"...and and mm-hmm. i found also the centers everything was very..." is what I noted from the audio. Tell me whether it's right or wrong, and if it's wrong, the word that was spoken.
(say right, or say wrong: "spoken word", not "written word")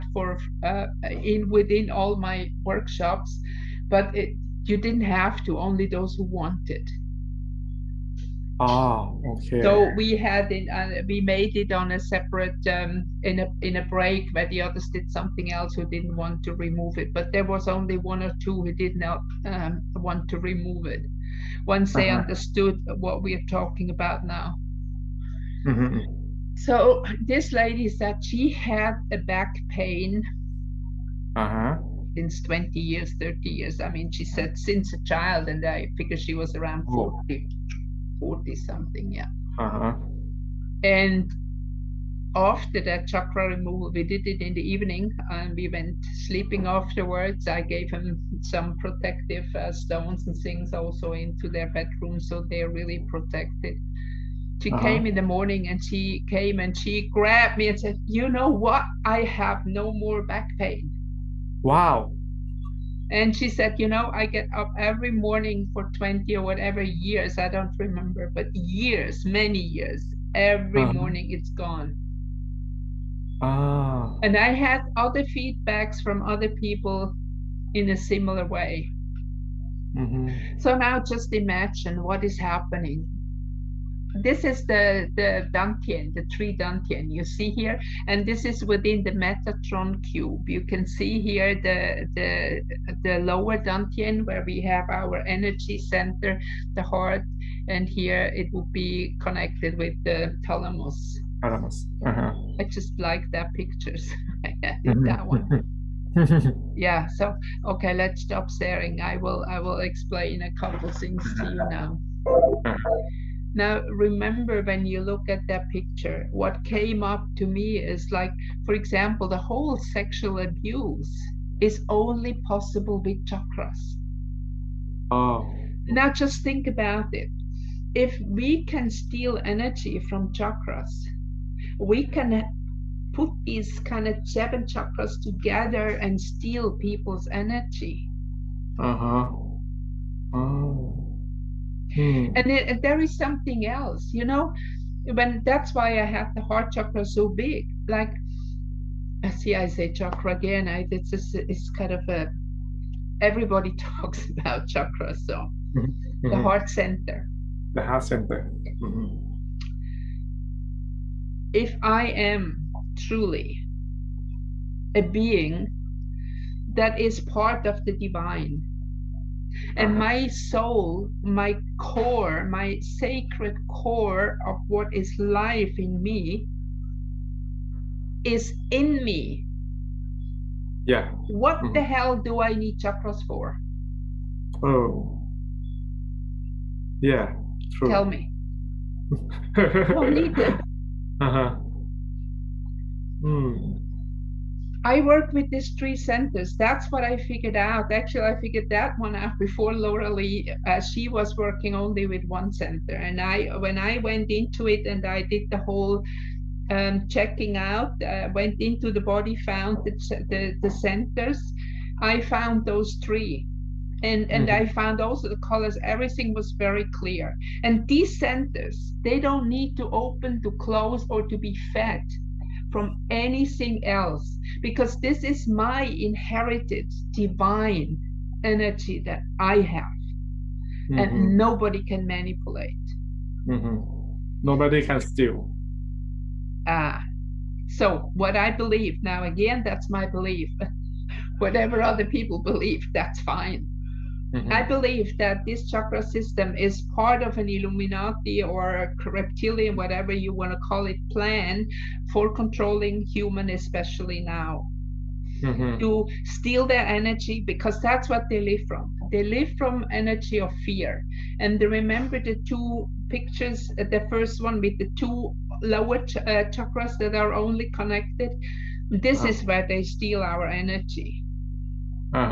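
wrong: "colors", not "centers".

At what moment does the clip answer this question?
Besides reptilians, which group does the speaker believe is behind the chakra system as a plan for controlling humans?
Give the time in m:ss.
4:07.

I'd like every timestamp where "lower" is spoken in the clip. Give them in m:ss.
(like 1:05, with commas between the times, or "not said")
1:33, 4:25.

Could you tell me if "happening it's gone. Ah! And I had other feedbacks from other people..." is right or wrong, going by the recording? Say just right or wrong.
wrong.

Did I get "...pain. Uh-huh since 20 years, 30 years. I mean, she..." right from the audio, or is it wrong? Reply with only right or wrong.
right.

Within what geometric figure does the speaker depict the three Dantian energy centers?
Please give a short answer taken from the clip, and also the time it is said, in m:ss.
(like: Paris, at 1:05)
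Metatron cube, at 1:29.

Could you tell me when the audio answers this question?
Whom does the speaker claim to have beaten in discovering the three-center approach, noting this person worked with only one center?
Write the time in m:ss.
3:19.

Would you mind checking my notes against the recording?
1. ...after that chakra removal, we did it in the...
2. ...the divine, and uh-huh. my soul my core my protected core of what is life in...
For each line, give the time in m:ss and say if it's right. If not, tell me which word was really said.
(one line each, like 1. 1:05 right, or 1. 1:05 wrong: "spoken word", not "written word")
1. 0:42 right
2. 2:47 wrong: "sacred", not "protected".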